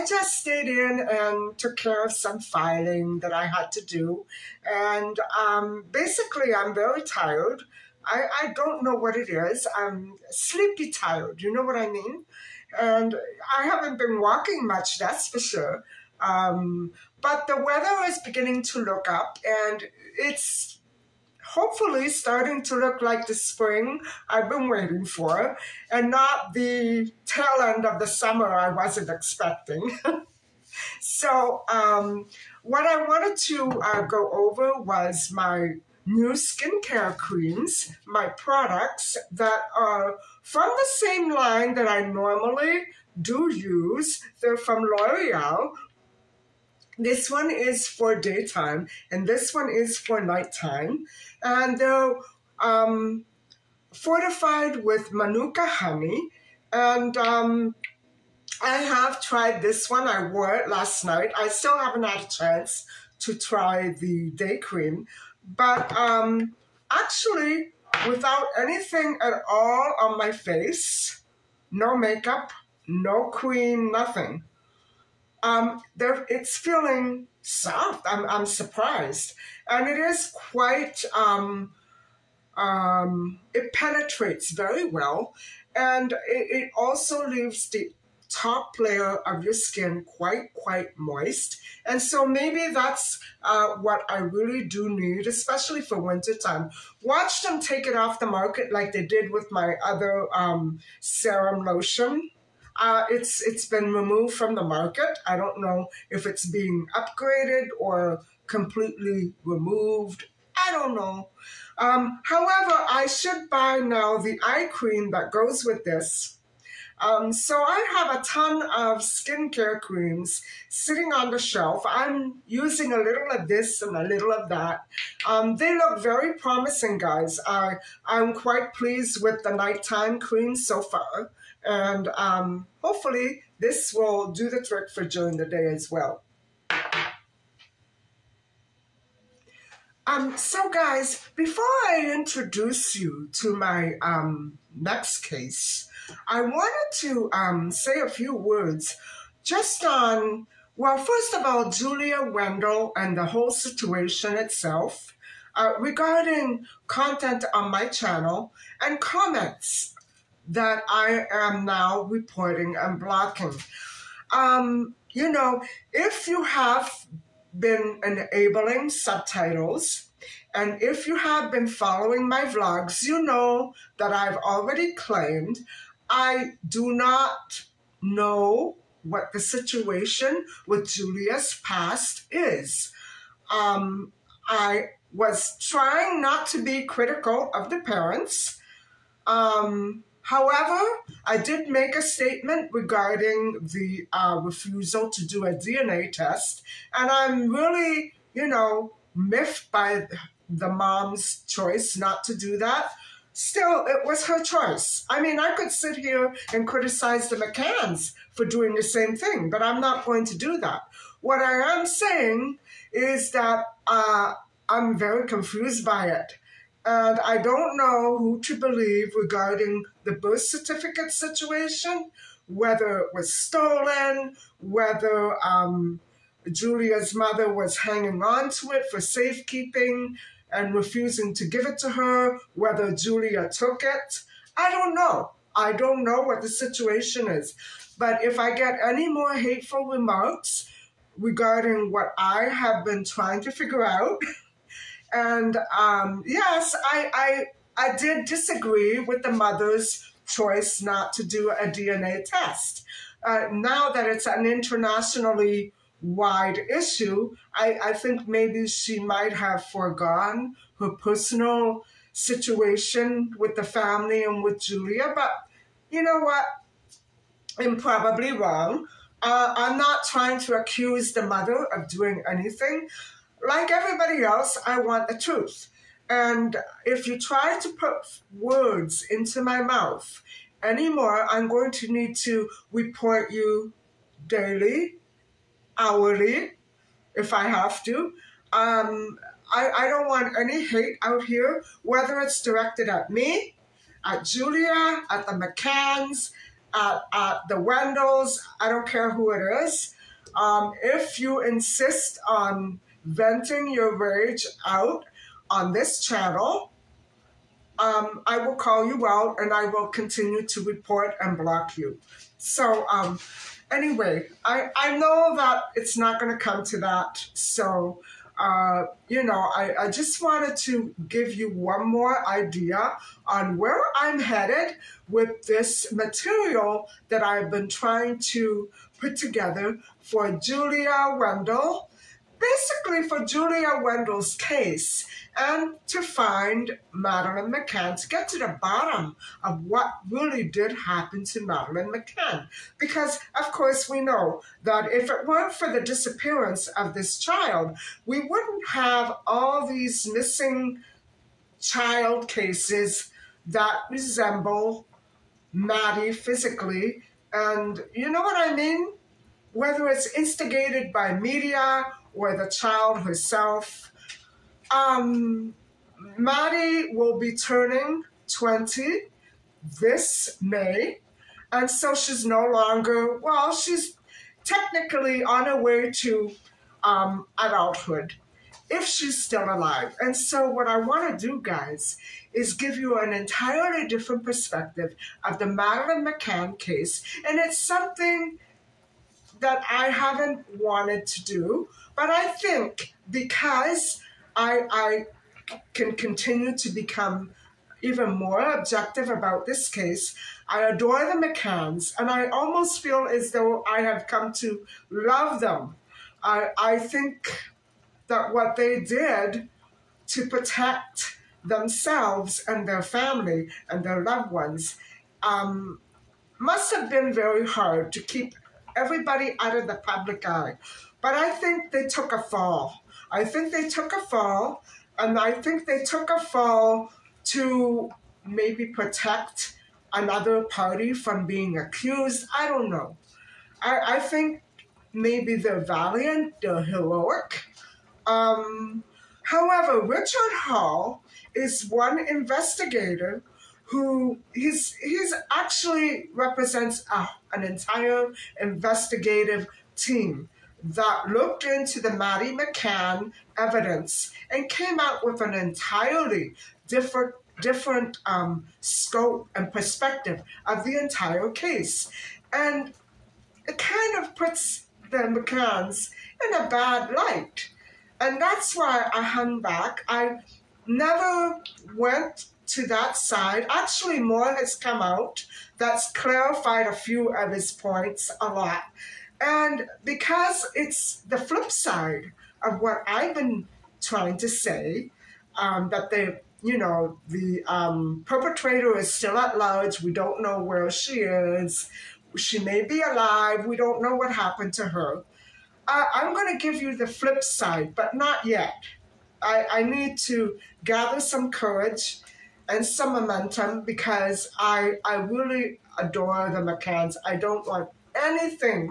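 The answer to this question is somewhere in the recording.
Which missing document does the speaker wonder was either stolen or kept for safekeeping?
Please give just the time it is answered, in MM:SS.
03:40.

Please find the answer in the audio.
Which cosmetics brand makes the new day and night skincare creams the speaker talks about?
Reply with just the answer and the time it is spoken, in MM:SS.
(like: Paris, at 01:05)
L'Oreal, at 00:44.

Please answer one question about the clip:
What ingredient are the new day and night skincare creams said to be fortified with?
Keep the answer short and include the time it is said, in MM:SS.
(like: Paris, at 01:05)
manuka honey, at 00:55.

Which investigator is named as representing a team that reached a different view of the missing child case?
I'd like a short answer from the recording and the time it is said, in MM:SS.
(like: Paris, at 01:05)
Richard Hall, at 07:19.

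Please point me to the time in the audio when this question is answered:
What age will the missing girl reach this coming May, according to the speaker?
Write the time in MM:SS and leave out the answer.
06:08.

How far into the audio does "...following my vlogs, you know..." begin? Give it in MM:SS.
02:51.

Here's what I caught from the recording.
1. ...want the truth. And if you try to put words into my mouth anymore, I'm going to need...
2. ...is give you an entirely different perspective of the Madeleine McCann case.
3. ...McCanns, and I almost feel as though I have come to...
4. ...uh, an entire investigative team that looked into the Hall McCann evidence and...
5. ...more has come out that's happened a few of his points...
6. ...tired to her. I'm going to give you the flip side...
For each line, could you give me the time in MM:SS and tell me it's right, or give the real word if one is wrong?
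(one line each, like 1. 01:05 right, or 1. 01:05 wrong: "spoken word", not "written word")
1. 04:34 right
2. 06:22 right
3. 06:41 right
4. 07:27 wrong: "Maddie", not "Hall"
5. 07:54 wrong: "clarified", not "happened"
6. 08:14 wrong: "happened", not "tired".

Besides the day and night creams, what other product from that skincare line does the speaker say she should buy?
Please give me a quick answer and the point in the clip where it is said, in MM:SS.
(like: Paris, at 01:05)
eye cream, at 01:54.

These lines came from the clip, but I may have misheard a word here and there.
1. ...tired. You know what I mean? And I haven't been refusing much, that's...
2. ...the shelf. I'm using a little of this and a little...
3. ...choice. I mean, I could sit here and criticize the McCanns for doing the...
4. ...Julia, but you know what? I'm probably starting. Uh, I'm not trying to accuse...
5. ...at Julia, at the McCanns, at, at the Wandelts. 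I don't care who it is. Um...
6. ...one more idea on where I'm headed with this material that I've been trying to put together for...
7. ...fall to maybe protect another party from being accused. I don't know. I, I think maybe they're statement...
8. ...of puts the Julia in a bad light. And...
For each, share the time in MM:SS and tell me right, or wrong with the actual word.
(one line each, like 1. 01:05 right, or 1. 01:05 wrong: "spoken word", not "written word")
1. 00:10 wrong: "walking", not "refusing"
2. 02:01 right
3. 03:24 right
4. 04:24 wrong: "wrong", not "starting"
5. 04:54 right
6. 05:21 right
7. 07:06 wrong: "valiant", not "statement"
8. 07:44 wrong: "McCanns", not "Julia".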